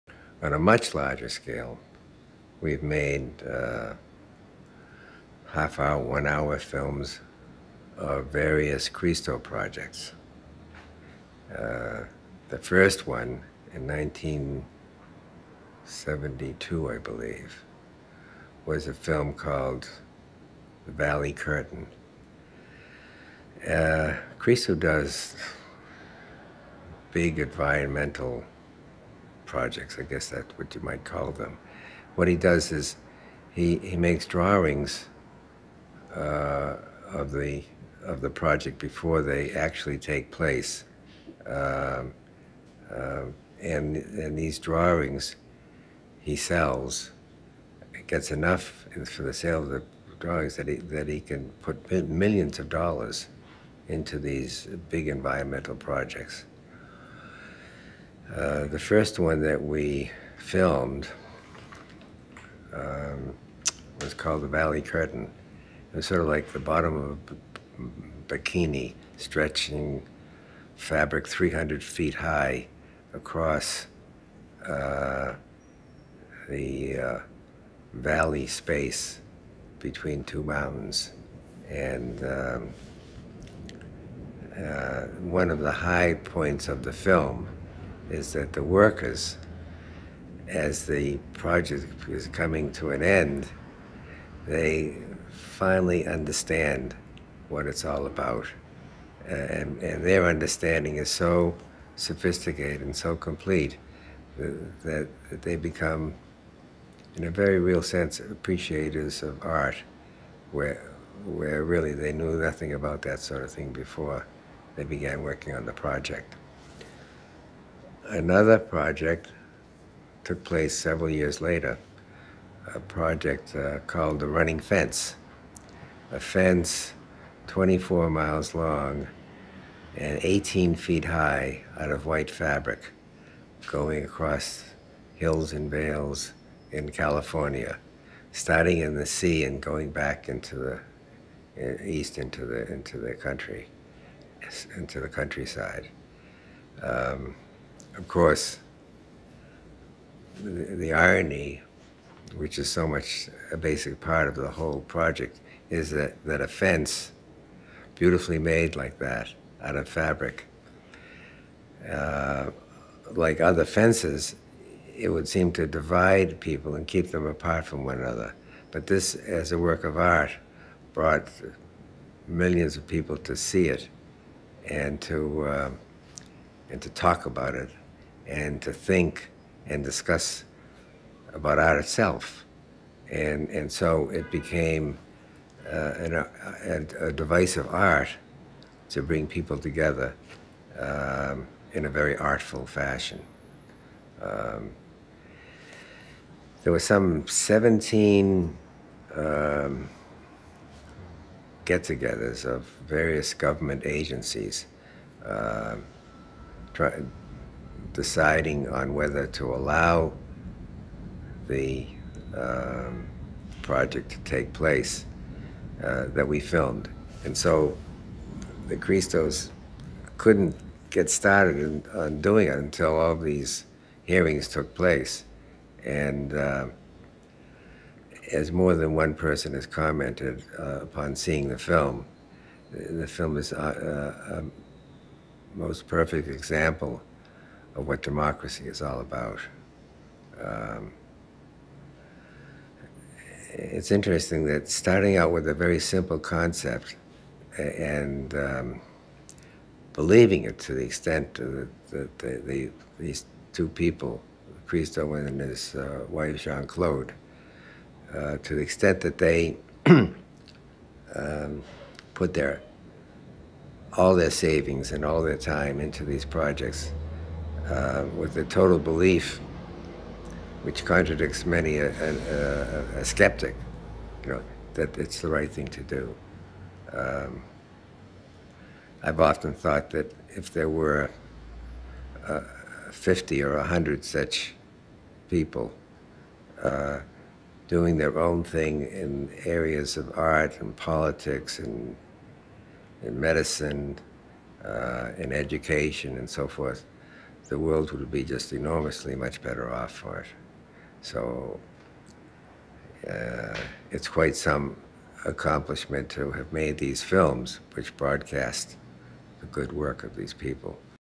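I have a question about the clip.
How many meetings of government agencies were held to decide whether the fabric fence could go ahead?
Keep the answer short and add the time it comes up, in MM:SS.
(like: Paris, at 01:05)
17, at 03:17.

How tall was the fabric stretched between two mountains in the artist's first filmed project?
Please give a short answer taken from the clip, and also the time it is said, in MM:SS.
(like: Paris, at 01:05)
300 feet, at 01:11.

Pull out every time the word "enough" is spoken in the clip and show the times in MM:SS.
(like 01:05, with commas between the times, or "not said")
00:48.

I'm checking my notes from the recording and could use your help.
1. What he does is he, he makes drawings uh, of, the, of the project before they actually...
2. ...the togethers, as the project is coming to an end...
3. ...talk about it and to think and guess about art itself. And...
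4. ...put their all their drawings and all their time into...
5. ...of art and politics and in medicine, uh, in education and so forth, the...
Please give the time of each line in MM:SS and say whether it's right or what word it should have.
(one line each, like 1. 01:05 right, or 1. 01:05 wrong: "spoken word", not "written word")
1. 00:32 right
2. 01:28 wrong: "workers", not "togethers"
3. 02:56 wrong: "discuss", not "guess"
4. 04:22 wrong: "savings", not "drawings"
5. 04:49 right.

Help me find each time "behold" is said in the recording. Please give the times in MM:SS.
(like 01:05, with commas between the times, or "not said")
not said.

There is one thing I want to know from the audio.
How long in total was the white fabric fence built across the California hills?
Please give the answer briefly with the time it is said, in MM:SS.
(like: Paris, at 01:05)
24 miles, at 02:07.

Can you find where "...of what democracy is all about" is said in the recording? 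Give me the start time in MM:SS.
03:57.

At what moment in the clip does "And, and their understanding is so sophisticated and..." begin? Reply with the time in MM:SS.
01:39.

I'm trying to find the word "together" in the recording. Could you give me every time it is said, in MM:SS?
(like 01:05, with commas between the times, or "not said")
03:09, 03:21.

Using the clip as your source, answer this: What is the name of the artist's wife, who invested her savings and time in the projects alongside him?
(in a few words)
Jean Claude.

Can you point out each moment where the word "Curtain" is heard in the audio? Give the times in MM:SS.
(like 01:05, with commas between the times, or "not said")
00:21, 01:04.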